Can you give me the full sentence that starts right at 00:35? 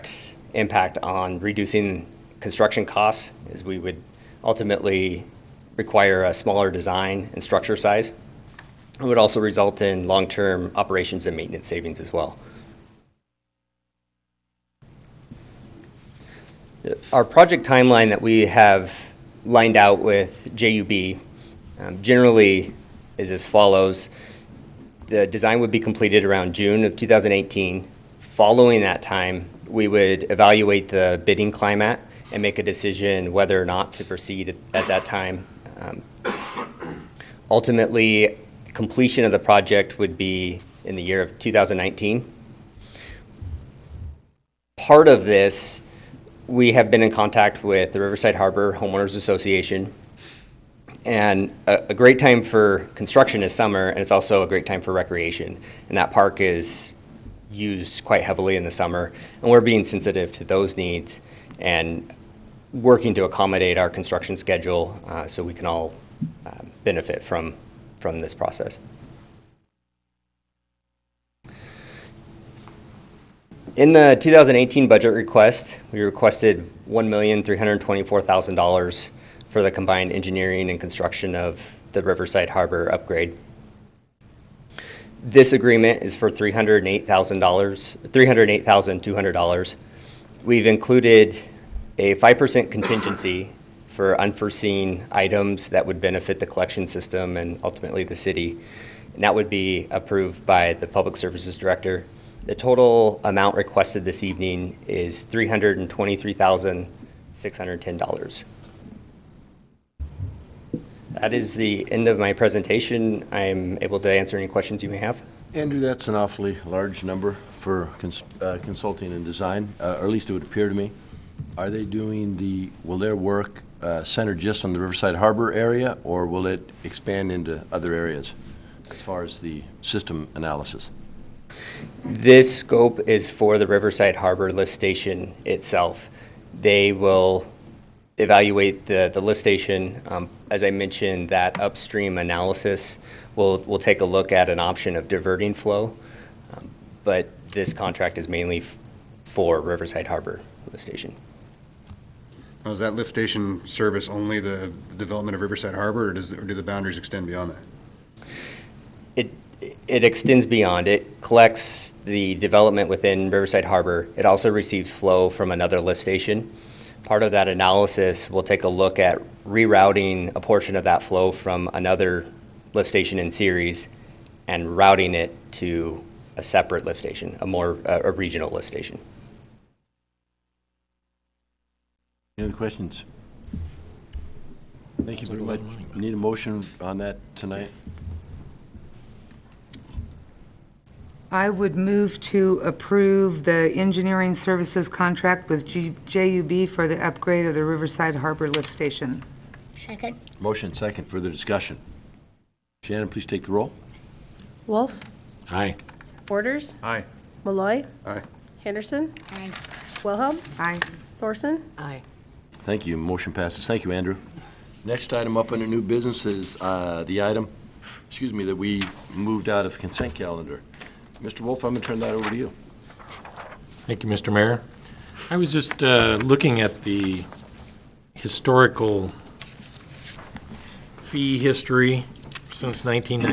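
Um, ultimately, completion of the project would be in the year of 2019.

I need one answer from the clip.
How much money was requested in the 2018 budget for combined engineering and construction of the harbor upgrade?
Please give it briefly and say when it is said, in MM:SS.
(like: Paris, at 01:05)
$1,324,000, at 01:16.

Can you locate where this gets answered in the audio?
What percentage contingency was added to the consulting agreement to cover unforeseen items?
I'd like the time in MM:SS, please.
01:32.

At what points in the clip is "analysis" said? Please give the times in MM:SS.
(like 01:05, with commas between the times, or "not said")
02:10, 02:22, 02:47.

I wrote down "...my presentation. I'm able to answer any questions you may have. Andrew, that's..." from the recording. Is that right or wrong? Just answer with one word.
right.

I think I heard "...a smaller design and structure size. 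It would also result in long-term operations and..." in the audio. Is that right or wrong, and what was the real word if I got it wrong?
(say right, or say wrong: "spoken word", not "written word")
right.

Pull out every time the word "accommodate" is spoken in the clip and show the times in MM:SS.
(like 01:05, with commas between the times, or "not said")
01:03.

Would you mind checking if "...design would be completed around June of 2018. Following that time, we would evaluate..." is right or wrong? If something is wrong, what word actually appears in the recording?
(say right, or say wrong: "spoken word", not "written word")
right.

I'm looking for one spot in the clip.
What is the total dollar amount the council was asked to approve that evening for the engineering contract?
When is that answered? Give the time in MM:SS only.
01:45.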